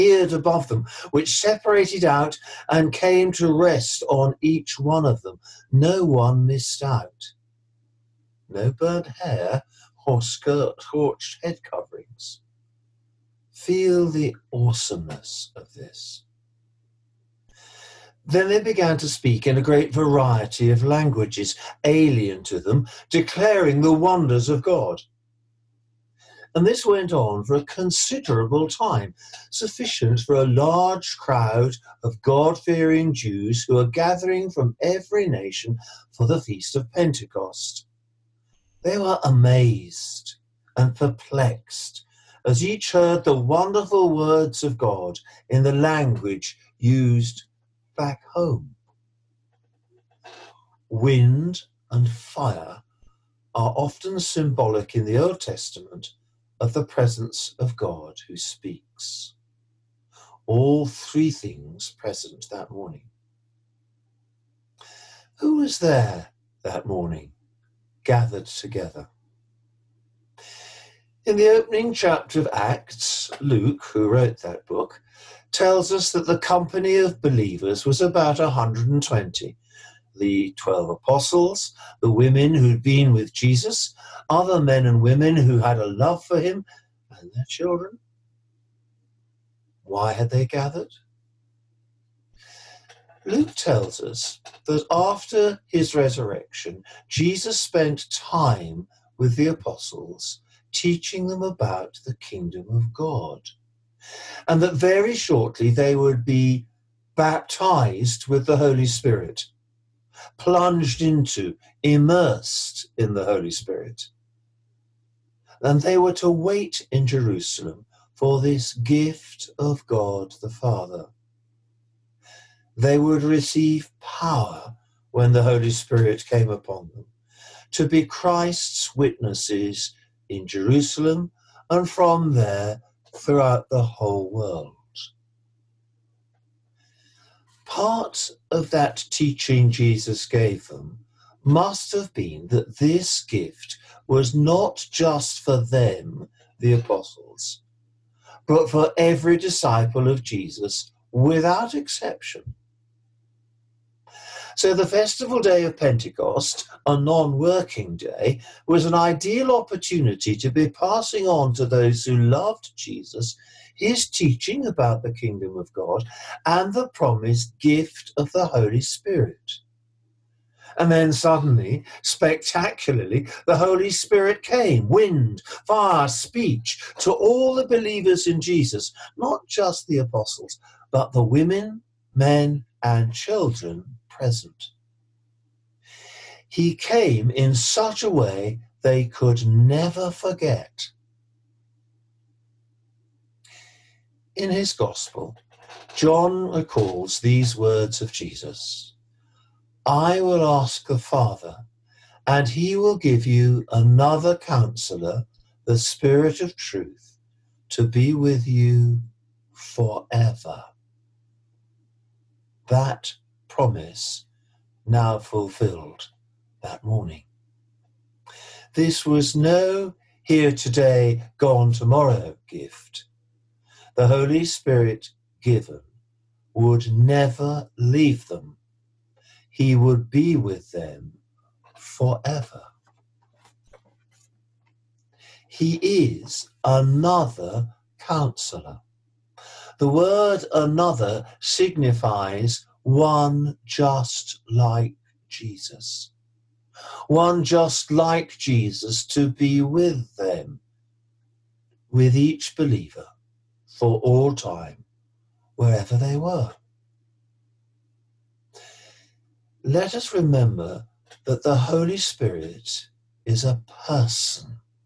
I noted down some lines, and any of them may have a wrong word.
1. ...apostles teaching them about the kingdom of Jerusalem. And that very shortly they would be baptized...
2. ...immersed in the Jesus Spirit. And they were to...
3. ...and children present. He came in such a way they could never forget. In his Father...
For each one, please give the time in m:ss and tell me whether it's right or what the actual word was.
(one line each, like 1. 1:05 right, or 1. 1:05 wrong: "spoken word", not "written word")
1. 1:39 wrong: "God", not "Jerusalem"
2. 1:51 wrong: "Holy", not "Jesus"
3. 3:02 wrong: "Gospel", not "Father".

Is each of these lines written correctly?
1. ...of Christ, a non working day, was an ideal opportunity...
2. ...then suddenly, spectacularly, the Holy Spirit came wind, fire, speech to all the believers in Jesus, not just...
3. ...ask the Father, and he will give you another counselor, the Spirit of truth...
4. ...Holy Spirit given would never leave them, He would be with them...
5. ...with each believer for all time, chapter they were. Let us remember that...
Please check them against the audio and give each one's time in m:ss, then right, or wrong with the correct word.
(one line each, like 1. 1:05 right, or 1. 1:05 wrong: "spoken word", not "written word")
1. 2:35 wrong: "Pentecost", not "Christ"
2. 2:50 right
3. 3:20 right
4. 3:44 right
5. 4:11 wrong: "wherever", not "chapter".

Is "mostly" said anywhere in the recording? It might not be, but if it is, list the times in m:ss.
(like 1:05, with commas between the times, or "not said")
not said.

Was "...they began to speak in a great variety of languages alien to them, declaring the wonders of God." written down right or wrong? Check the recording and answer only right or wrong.
right.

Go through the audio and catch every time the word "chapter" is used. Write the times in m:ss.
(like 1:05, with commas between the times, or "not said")
1:11.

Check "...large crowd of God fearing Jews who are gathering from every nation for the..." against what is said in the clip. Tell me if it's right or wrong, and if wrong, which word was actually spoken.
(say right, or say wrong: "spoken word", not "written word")
right.